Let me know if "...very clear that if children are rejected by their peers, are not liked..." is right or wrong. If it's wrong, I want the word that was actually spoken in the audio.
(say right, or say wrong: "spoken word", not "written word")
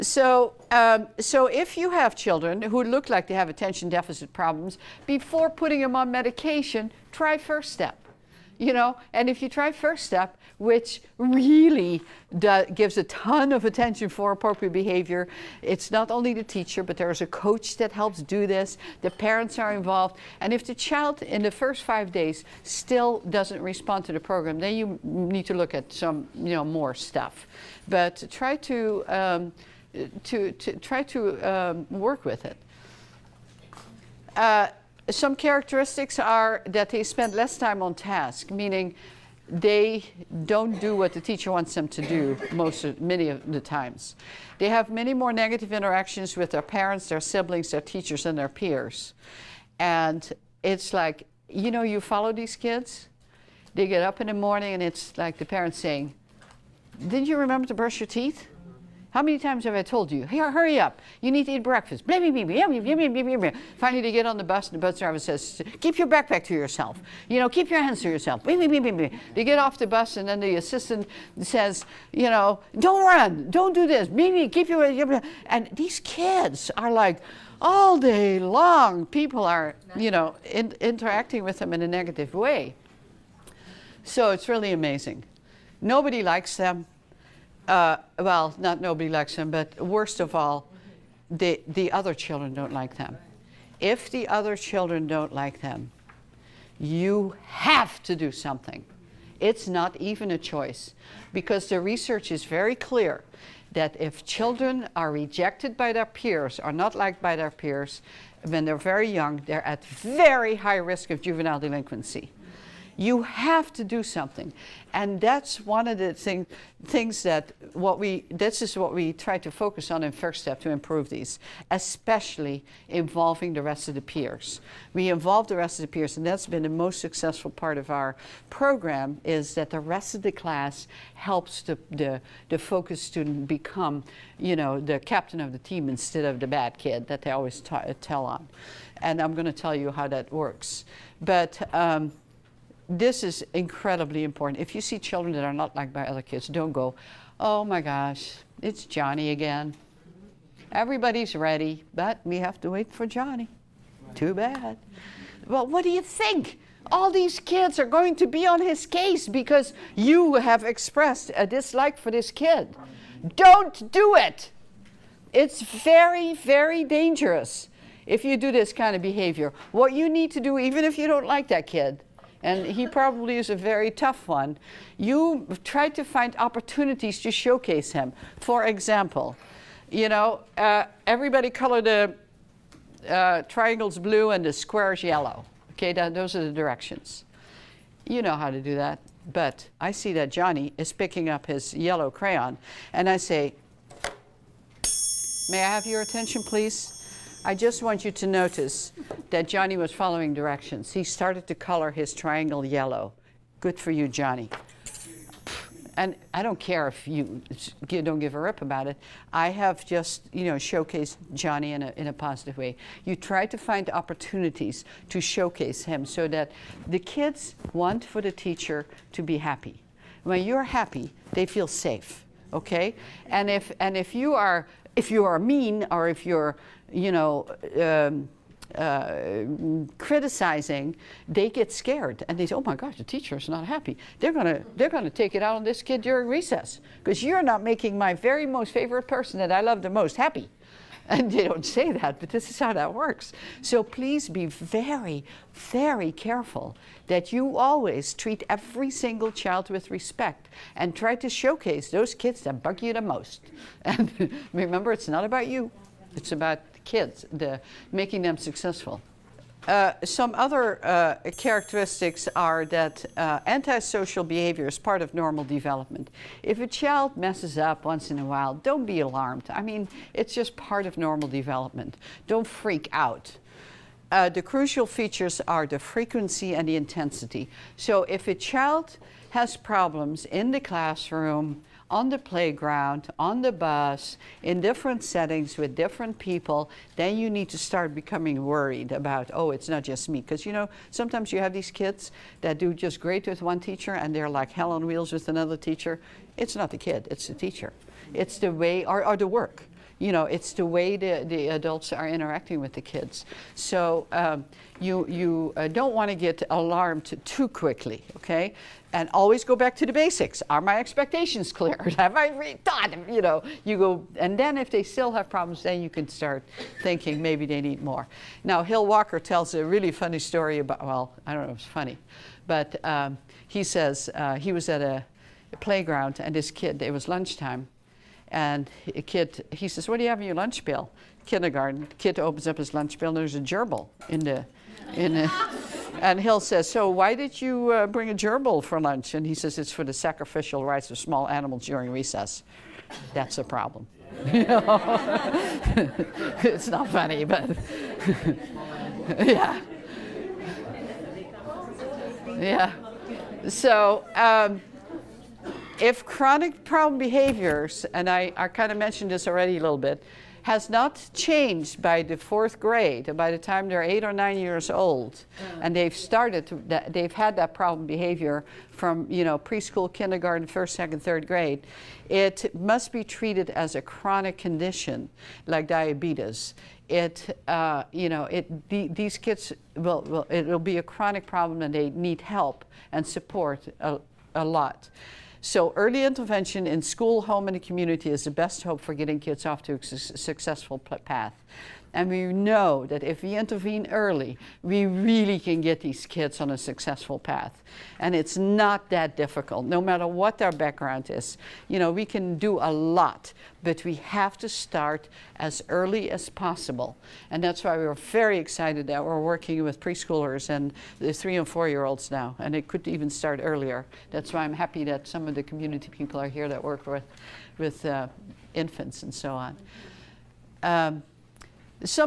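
right.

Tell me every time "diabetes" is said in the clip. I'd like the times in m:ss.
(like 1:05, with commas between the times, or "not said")
6:15.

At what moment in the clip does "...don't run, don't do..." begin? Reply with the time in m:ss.
1:12.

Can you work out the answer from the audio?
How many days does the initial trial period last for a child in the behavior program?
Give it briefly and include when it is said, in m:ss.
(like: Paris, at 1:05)
5, at 0:21.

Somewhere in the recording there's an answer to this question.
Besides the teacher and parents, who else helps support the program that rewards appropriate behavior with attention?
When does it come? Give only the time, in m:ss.
0:17.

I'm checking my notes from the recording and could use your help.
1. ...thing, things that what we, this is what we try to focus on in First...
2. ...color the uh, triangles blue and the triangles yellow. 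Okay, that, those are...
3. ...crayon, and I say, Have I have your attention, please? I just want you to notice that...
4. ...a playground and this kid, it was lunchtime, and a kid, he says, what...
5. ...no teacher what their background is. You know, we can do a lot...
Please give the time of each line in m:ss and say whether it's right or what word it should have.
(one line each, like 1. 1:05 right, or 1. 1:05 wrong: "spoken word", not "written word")
1. 1:56 right
2. 3:01 wrong: "squares", not "triangles"
3. 3:12 wrong: "May", not "Have"
4. 5:25 right
5. 6:39 wrong: "matter", not "teacher".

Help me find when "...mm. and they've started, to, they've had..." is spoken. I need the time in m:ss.
6:05.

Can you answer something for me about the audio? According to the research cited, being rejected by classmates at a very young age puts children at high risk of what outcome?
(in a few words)
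juvenile delinquency.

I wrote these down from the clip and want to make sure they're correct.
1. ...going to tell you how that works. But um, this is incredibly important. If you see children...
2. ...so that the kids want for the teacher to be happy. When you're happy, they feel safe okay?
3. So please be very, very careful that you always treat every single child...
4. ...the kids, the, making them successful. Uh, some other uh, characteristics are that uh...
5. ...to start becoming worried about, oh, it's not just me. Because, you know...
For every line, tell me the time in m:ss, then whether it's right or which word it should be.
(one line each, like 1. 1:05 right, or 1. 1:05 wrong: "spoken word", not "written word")
1. 2:19 right
2. 3:36 right
3. 4:03 right
4. 4:16 right
5. 4:47 right.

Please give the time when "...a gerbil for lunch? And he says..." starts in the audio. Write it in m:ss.
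5:38.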